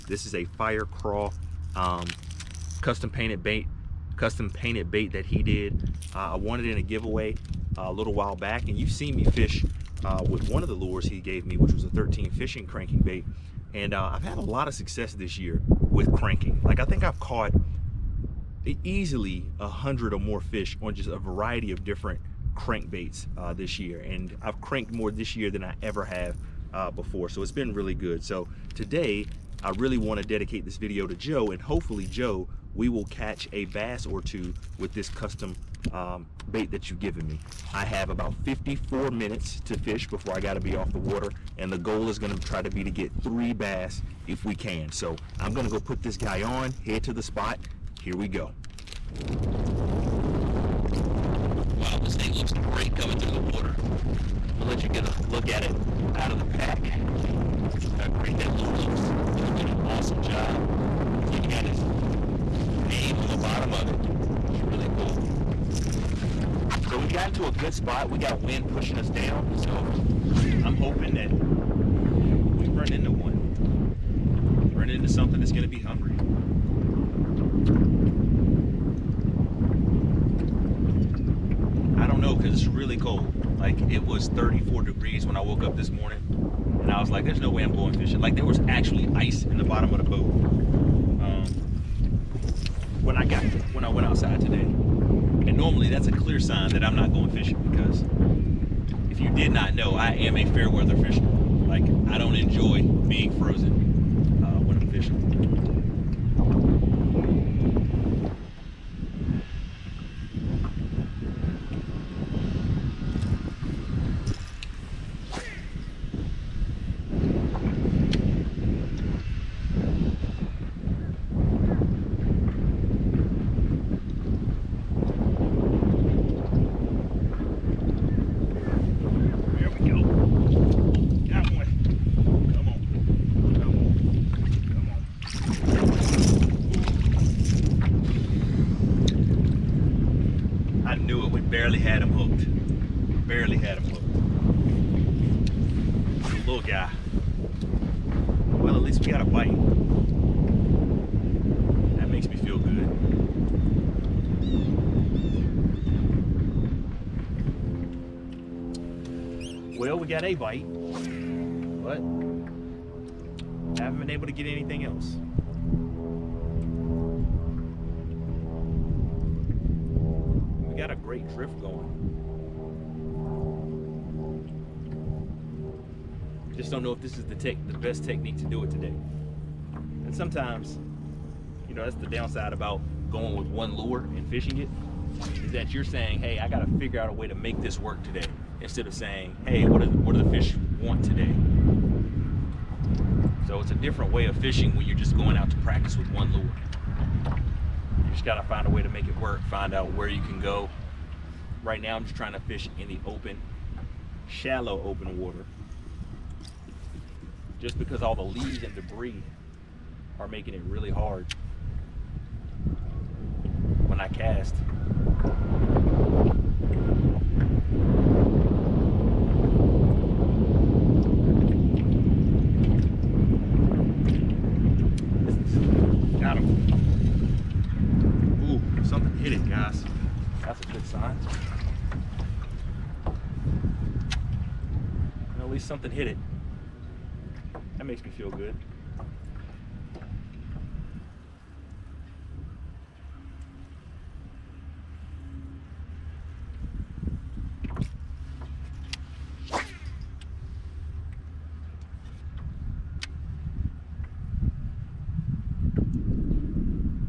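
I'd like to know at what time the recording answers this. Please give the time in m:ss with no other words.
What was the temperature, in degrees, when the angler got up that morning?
1:24.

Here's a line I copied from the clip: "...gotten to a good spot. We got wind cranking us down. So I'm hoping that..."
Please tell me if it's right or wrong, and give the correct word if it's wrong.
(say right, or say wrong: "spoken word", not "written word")
wrong: "pushing", not "cranking".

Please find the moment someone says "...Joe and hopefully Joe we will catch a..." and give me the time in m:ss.
0:31.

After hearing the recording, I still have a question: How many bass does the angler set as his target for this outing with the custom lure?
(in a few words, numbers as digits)
3.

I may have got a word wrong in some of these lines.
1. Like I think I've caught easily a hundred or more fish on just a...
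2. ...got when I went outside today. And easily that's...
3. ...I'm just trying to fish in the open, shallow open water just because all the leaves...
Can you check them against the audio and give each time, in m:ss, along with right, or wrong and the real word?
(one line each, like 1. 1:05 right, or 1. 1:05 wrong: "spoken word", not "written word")
1. 0:16 right
2. 1:33 wrong: "normally", not "easily"
3. 3:21 right.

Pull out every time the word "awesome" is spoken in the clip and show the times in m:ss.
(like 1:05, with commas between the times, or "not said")
0:59.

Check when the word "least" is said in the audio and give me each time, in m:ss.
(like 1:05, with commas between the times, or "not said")
2:28, 3:55.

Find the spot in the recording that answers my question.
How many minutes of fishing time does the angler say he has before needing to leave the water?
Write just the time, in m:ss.
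0:38.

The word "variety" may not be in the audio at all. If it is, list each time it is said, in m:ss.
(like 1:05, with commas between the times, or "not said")
0:21.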